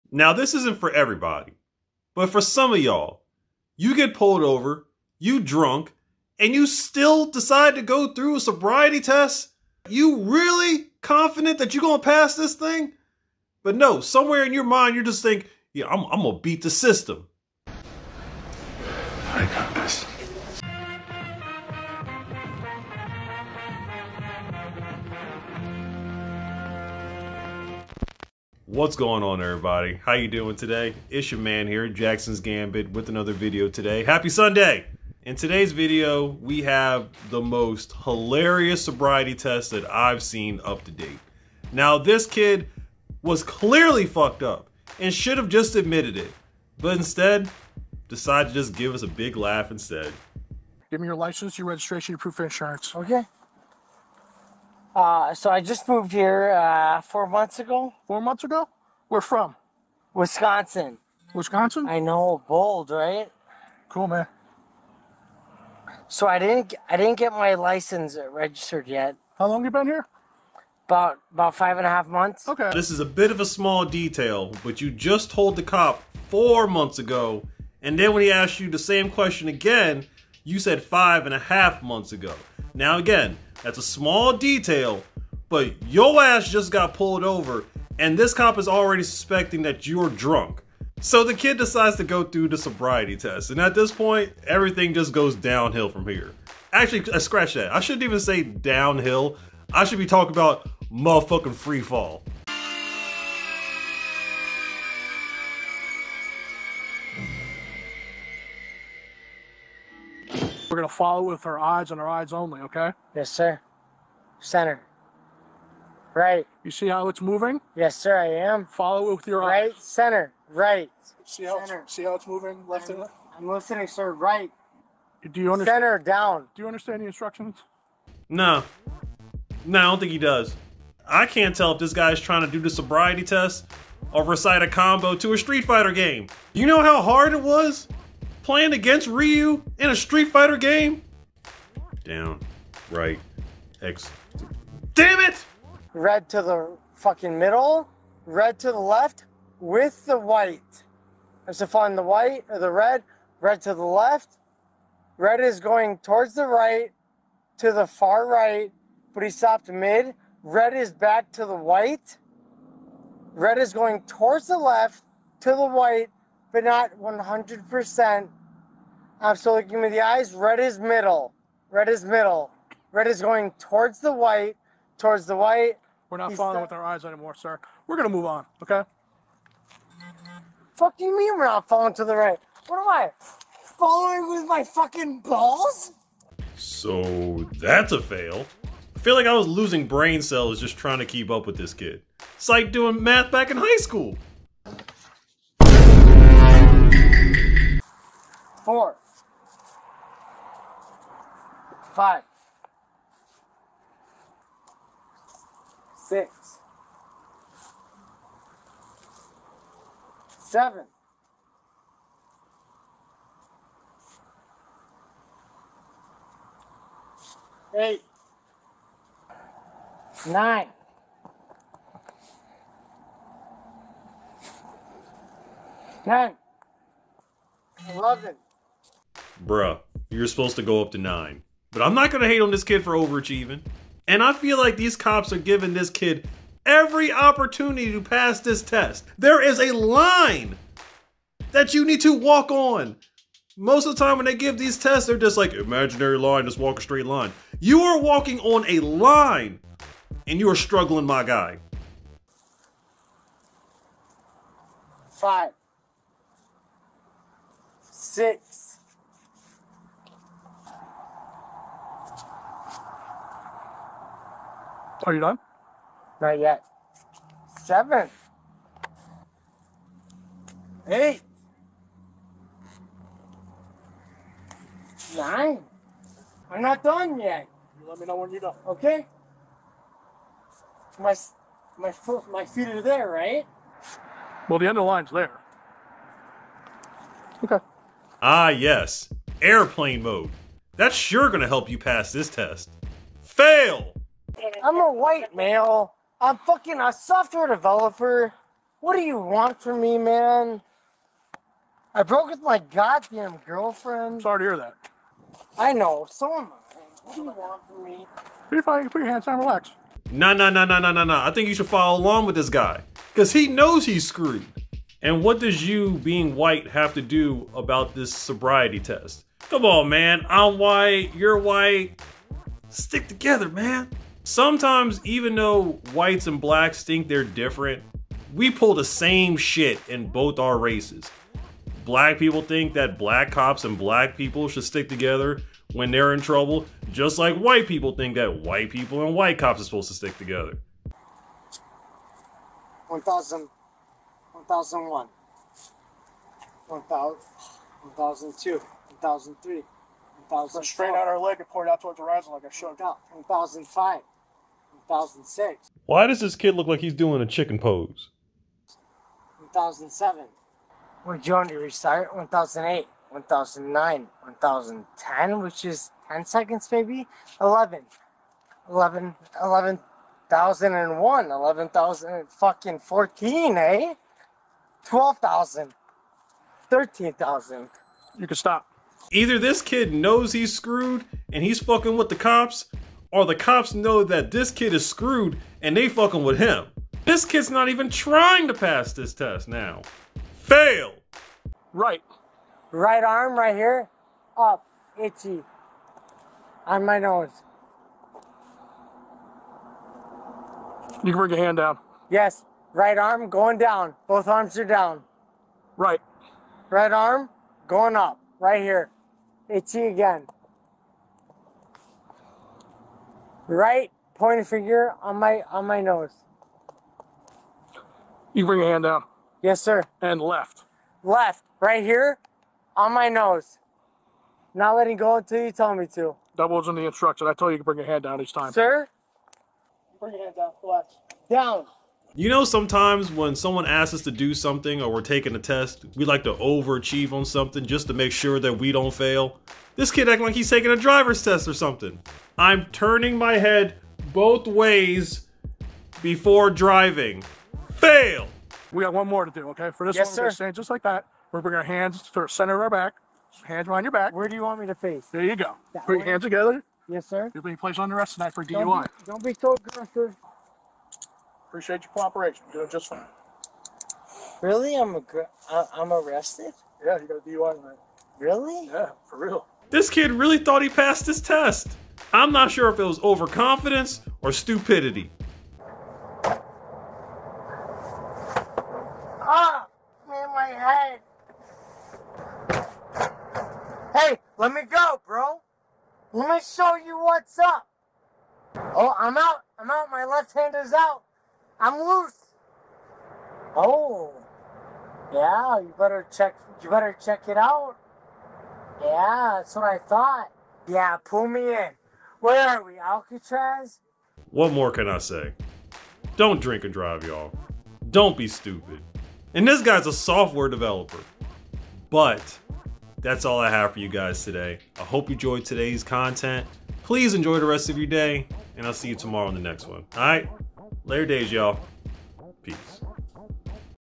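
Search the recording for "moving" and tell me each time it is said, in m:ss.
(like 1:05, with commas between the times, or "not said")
1:57, 2:02.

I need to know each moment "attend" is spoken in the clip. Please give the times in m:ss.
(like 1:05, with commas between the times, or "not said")
not said.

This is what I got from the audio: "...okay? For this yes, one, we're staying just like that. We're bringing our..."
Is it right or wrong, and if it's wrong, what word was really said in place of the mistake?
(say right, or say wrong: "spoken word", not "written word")
right.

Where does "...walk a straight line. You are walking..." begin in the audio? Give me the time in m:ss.
4:06.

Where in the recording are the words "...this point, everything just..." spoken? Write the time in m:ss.
1:33.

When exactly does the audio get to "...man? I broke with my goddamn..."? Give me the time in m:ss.
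4:59.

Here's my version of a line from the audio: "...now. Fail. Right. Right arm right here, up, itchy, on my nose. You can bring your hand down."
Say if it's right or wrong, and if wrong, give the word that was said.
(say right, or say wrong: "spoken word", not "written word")
right.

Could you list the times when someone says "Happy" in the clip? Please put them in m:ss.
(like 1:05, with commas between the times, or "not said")
0:34.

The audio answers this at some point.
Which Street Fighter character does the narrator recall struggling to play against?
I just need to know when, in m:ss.
2:19.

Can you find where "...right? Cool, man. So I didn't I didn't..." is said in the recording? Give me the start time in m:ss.
1:02.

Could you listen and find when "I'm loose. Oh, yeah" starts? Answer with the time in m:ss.
8:11.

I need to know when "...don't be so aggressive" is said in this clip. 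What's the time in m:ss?
7:39.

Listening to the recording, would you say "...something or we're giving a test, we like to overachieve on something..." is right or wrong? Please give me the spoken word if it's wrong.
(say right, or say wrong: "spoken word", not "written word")
wrong: "taking", not "giving".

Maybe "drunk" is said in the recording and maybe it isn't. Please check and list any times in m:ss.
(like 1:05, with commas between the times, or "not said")
0:05, 1:30.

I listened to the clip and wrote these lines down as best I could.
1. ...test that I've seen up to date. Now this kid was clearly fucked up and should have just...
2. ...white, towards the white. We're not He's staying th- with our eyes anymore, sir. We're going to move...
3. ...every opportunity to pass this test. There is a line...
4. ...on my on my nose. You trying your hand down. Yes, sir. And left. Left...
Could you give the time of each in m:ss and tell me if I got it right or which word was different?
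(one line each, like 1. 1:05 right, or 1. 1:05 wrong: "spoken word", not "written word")
1. 0:39 right
2. 2:54 wrong: "following", not "staying"
3. 3:56 right
4. 6:55 wrong: "bring", not "trying".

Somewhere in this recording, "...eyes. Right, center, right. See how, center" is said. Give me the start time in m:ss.
1:59.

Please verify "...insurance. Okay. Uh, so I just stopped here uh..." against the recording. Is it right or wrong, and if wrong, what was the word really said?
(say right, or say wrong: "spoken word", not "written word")
wrong: "moved", not "stopped".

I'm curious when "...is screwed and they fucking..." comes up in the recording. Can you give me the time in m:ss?
6:24.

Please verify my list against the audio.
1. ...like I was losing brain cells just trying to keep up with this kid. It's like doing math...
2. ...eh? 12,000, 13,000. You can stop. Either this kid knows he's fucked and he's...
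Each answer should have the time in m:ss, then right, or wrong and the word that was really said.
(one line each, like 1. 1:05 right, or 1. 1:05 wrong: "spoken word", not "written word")
1. 3:09 right
2. 6:13 wrong: "screwed", not "fucked".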